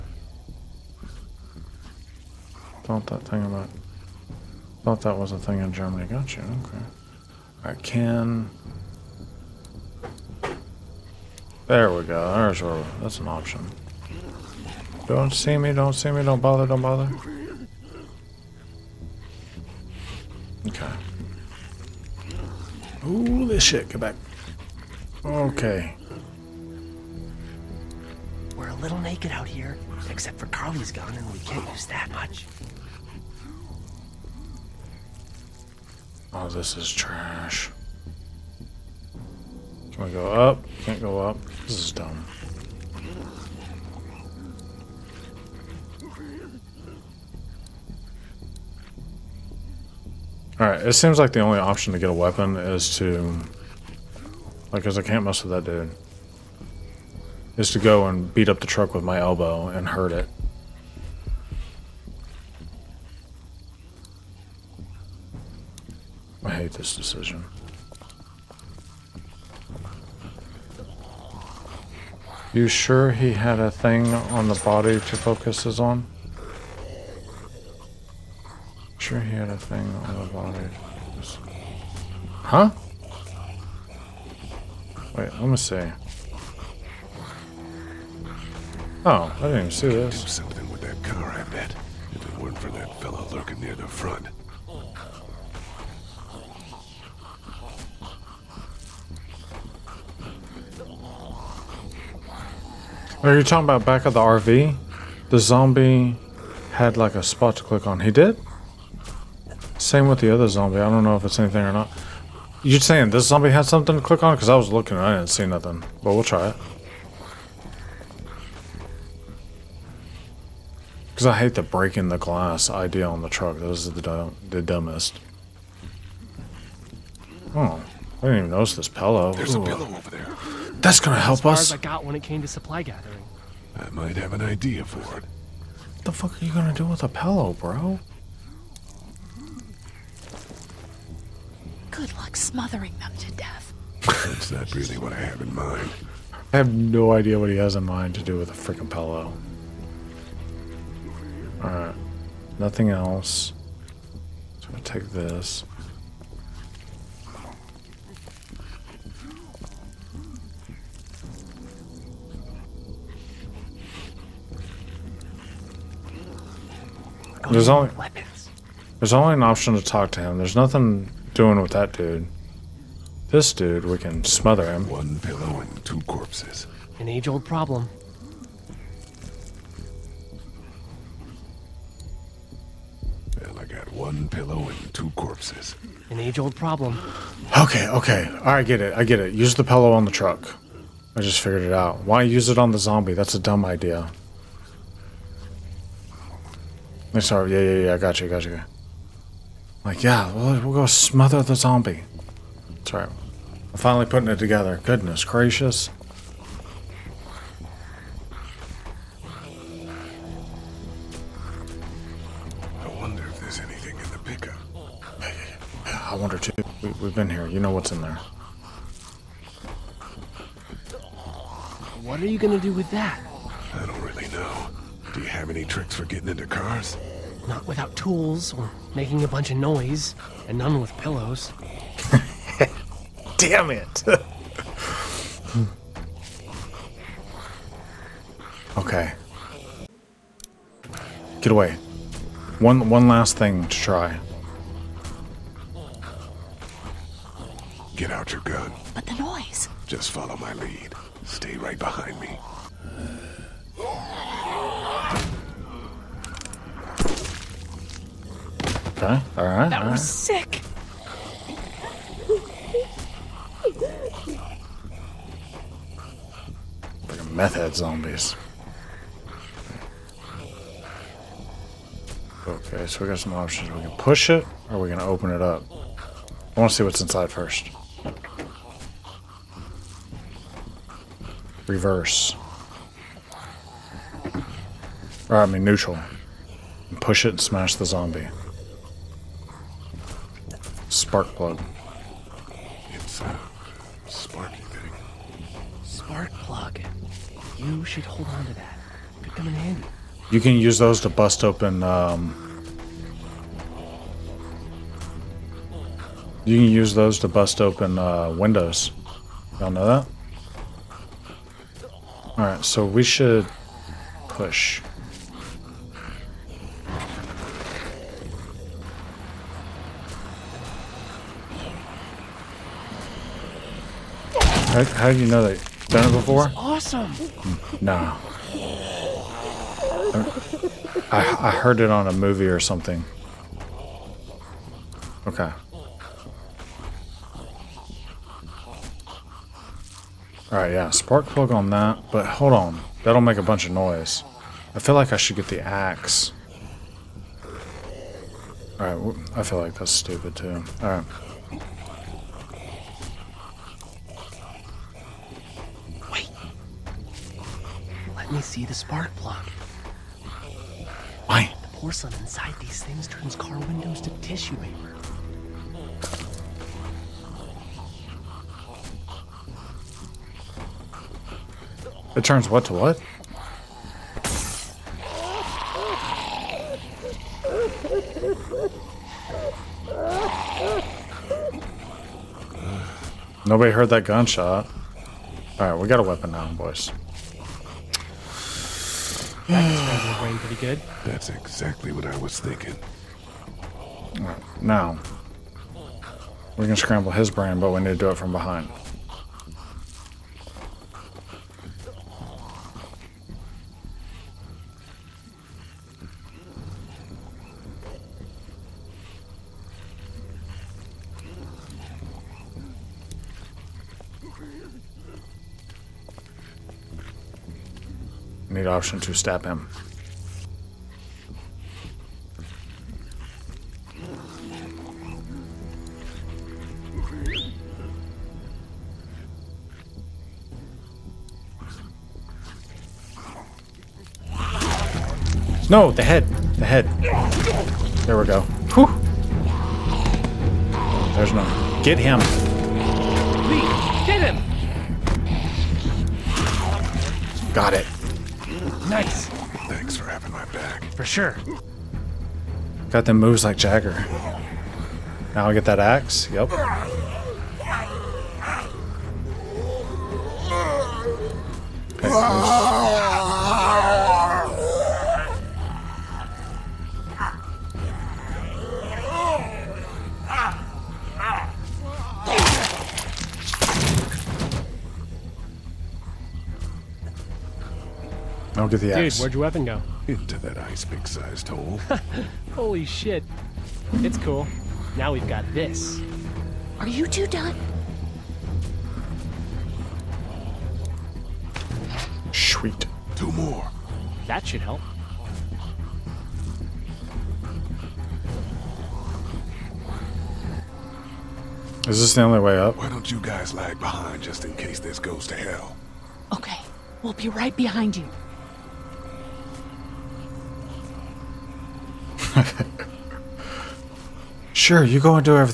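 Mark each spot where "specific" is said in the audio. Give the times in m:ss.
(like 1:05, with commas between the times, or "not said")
not said.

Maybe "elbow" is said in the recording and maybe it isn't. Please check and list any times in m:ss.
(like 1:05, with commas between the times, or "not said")
0:59.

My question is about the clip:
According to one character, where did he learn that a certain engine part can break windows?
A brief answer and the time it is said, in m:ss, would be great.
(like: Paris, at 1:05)
a movie, at 5:31.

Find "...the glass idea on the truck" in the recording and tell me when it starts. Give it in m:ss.
2:02.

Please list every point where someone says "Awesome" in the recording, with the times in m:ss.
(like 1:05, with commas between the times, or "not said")
5:26.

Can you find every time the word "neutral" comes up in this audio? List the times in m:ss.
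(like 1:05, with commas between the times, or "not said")
4:45.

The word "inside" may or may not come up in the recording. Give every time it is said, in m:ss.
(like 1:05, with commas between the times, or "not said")
4:36, 6:02.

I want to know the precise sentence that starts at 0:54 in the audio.
Like, because I can't mess with that dude.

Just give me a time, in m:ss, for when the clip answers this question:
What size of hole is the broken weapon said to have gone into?
8:00.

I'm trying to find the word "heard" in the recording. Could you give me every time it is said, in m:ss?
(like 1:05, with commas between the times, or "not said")
5:31, 6:23.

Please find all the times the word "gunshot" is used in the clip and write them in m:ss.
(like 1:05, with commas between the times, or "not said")
6:24.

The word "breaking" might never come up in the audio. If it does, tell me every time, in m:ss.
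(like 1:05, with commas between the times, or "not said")
2:01.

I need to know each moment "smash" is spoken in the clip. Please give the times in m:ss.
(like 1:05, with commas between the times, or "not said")
4:47.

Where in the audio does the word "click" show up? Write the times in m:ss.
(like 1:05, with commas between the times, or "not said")
1:47, 1:54.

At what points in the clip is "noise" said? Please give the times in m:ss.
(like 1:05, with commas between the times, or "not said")
3:49, 4:09, 5:43.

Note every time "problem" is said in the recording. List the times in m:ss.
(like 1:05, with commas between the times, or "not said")
2:57, 3:06.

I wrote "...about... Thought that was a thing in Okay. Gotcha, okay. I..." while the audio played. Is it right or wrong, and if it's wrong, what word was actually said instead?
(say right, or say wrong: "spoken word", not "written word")
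wrong: "Germany", not "Okay".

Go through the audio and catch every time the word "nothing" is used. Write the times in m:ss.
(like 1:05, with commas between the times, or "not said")
1:55, 2:32, 2:50.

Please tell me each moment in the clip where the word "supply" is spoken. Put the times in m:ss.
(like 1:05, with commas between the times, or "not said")
2:12.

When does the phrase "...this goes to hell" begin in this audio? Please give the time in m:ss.
8:24.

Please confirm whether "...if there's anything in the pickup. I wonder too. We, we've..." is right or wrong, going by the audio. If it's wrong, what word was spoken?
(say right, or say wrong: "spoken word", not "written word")
right.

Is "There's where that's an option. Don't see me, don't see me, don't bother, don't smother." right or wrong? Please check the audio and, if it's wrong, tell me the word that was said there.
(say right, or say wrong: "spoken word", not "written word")
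wrong: "bother", not "smother".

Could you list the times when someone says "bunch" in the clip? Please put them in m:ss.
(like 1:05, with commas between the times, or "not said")
3:49, 5:43.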